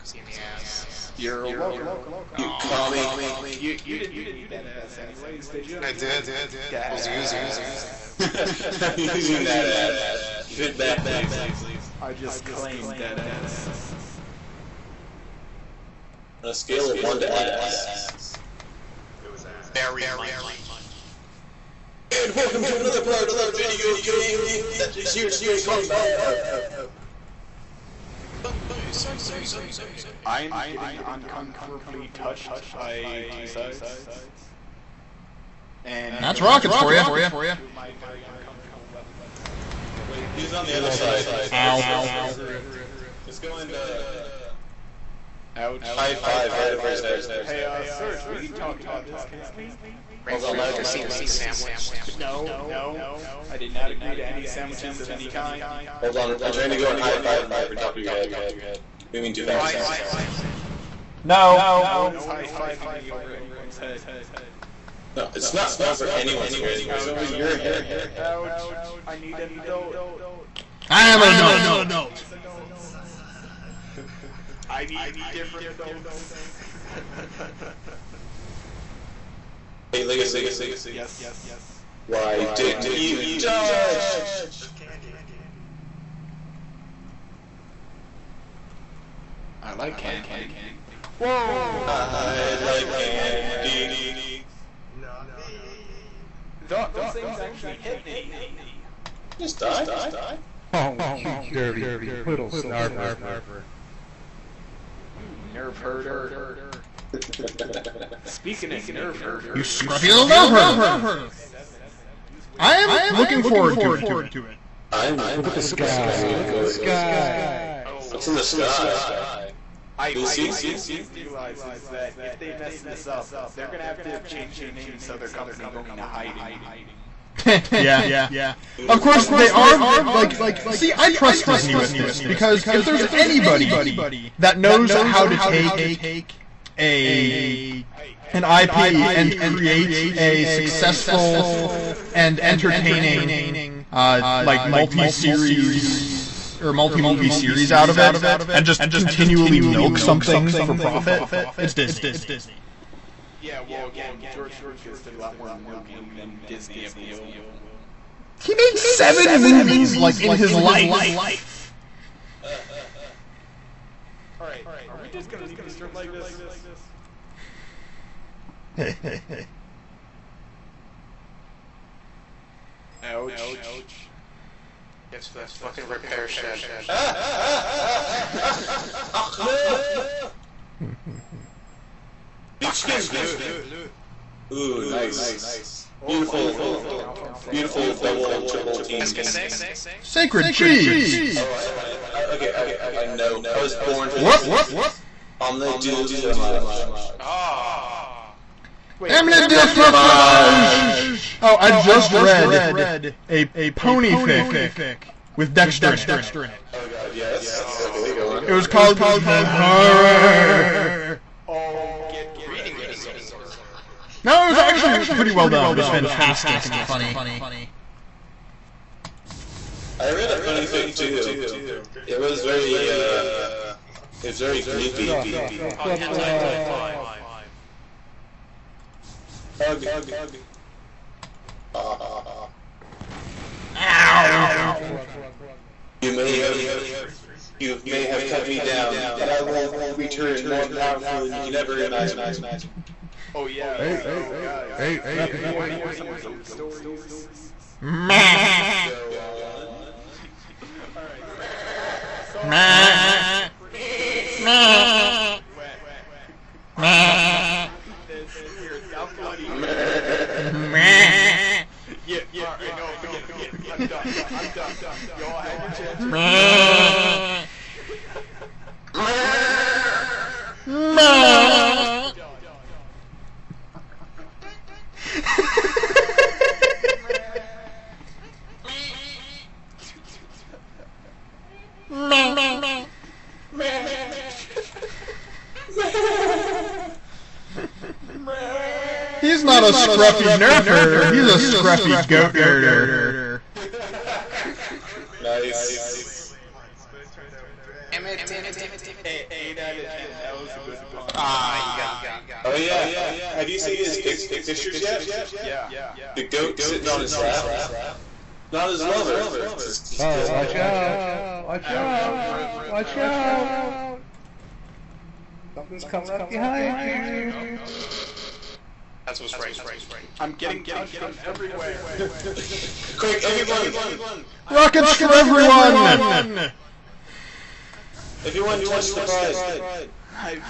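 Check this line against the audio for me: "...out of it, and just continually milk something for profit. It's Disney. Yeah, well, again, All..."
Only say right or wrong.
wrong.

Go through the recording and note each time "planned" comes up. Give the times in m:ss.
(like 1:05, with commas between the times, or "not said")
not said.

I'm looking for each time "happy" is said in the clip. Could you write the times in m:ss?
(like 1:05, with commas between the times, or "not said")
not said.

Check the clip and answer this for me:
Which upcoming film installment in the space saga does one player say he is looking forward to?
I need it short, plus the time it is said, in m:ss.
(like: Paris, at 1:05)
Episode 7, at 1:50.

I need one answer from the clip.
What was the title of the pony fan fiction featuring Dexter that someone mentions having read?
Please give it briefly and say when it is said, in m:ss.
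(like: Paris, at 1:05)
The Horror, at 3:29.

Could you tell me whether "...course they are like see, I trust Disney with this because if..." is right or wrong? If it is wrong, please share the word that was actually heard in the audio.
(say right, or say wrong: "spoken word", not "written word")
right.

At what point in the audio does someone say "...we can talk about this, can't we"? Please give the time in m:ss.
0:48.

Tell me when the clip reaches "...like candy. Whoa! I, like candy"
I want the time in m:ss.
1:29.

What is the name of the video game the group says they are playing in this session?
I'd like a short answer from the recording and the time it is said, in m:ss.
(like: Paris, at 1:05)
Mav, at 0:25.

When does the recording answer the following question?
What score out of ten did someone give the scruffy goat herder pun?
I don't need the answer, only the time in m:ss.
4:59.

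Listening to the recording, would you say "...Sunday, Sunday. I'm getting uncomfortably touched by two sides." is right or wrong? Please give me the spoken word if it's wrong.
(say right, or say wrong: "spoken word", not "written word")
right.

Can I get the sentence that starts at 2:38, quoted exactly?
He made seven movies, like, in his life.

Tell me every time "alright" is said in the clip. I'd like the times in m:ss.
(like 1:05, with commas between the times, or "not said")
2:44, 4:22.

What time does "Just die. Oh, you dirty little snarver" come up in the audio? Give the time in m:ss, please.
1:39.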